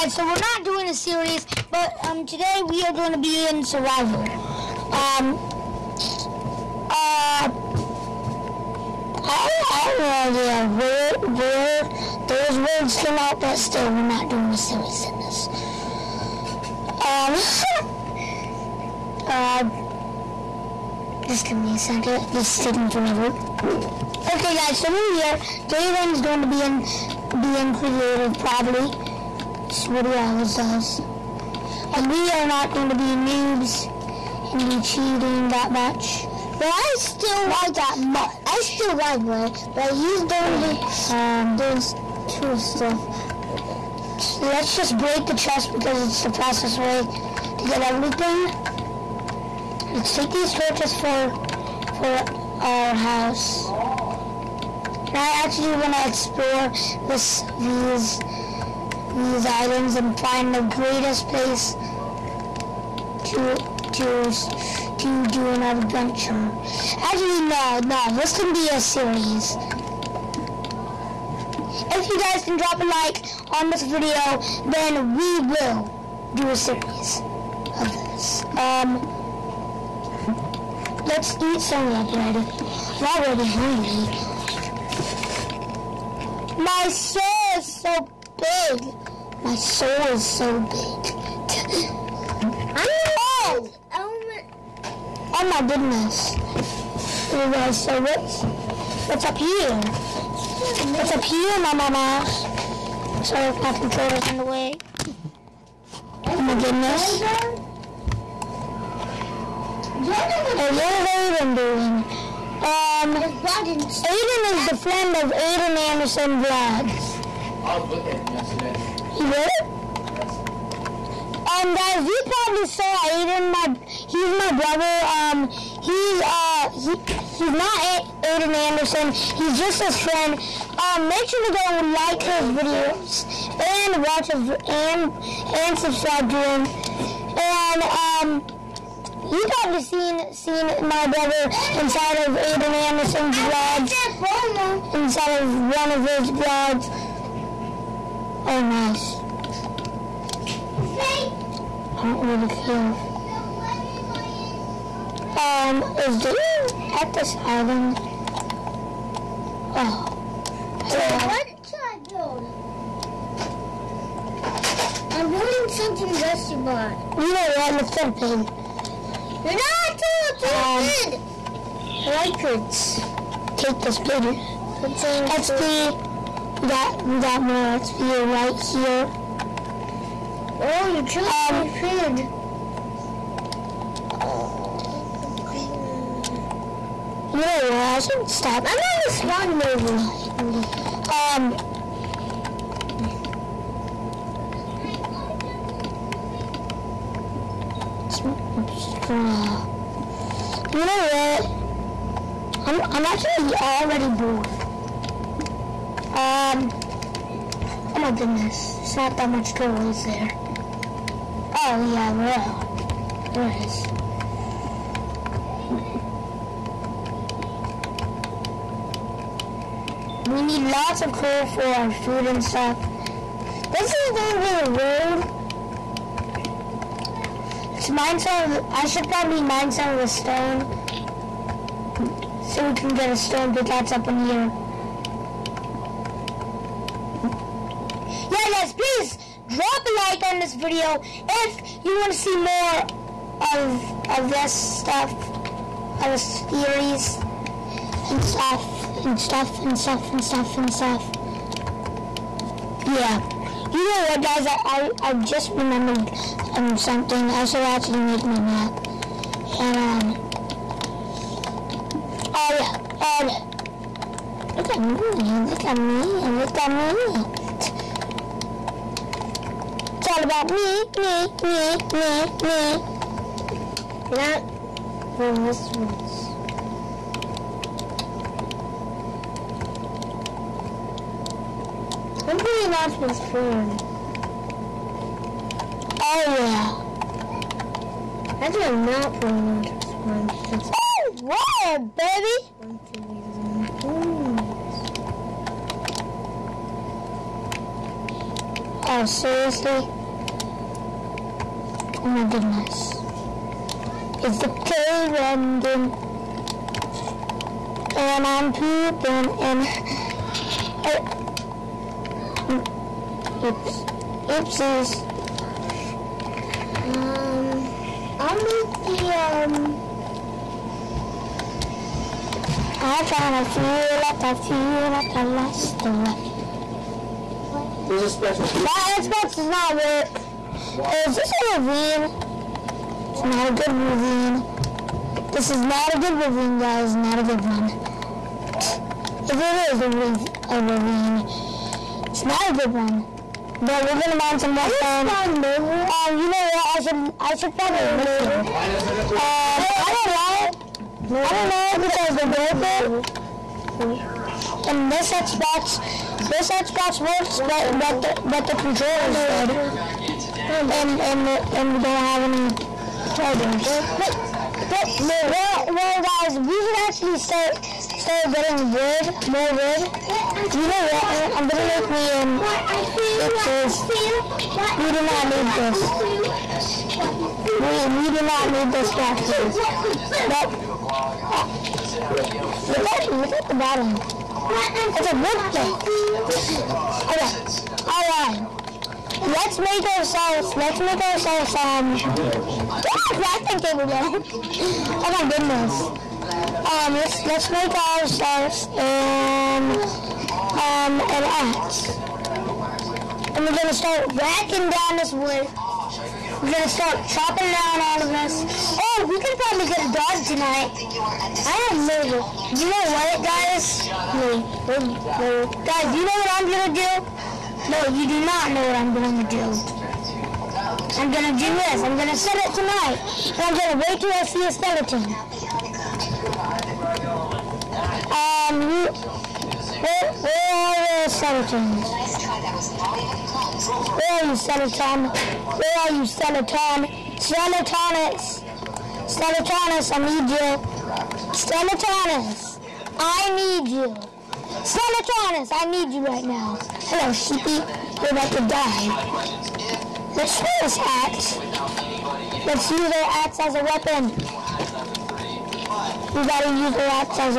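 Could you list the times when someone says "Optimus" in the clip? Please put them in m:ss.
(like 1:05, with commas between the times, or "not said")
4:42, 4:49.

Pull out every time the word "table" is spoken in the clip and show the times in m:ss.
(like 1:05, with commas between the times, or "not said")
6:33.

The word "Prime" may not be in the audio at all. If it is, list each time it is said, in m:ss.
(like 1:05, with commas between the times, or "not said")
4:43, 4:50.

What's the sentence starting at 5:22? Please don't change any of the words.
I'm trying to feel like I feel like I lost the life.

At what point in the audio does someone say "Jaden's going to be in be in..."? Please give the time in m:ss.
0:25.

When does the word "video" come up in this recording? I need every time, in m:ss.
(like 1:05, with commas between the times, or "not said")
1:13, 2:12, 4:00.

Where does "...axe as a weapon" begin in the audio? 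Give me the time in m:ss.
7:33.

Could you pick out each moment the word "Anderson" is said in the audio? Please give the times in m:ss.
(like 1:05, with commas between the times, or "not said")
1:55, 2:08, 2:22.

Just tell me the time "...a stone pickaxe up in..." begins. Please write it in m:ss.
3:53.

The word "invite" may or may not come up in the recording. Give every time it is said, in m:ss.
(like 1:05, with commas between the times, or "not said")
not said.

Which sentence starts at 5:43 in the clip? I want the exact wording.
But we're gonna mine some more stone.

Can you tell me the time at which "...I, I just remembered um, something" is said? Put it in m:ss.
4:14.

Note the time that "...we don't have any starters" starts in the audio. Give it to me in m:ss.
6:01.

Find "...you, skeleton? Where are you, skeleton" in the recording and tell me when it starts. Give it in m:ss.
7:14.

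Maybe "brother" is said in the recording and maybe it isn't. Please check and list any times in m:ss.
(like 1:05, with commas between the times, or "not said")
2:04, 2:21.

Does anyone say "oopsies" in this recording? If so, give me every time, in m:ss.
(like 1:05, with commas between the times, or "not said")
5:14, 6:13.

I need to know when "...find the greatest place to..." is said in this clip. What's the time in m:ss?
1:00.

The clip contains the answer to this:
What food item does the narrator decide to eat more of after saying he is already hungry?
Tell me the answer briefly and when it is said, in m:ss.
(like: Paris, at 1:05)
Bread, at 1:22.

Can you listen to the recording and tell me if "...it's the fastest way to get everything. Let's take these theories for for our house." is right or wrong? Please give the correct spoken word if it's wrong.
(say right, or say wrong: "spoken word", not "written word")
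wrong: "torches", not "theories".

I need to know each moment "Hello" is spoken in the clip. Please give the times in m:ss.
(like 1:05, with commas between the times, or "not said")
2:40, 7:26.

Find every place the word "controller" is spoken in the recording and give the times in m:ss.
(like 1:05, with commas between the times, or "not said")
1:43, 5:58.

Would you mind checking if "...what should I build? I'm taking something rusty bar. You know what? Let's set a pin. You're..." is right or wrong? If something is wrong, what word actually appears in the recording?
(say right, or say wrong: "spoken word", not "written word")
wrong: "building", not "taking".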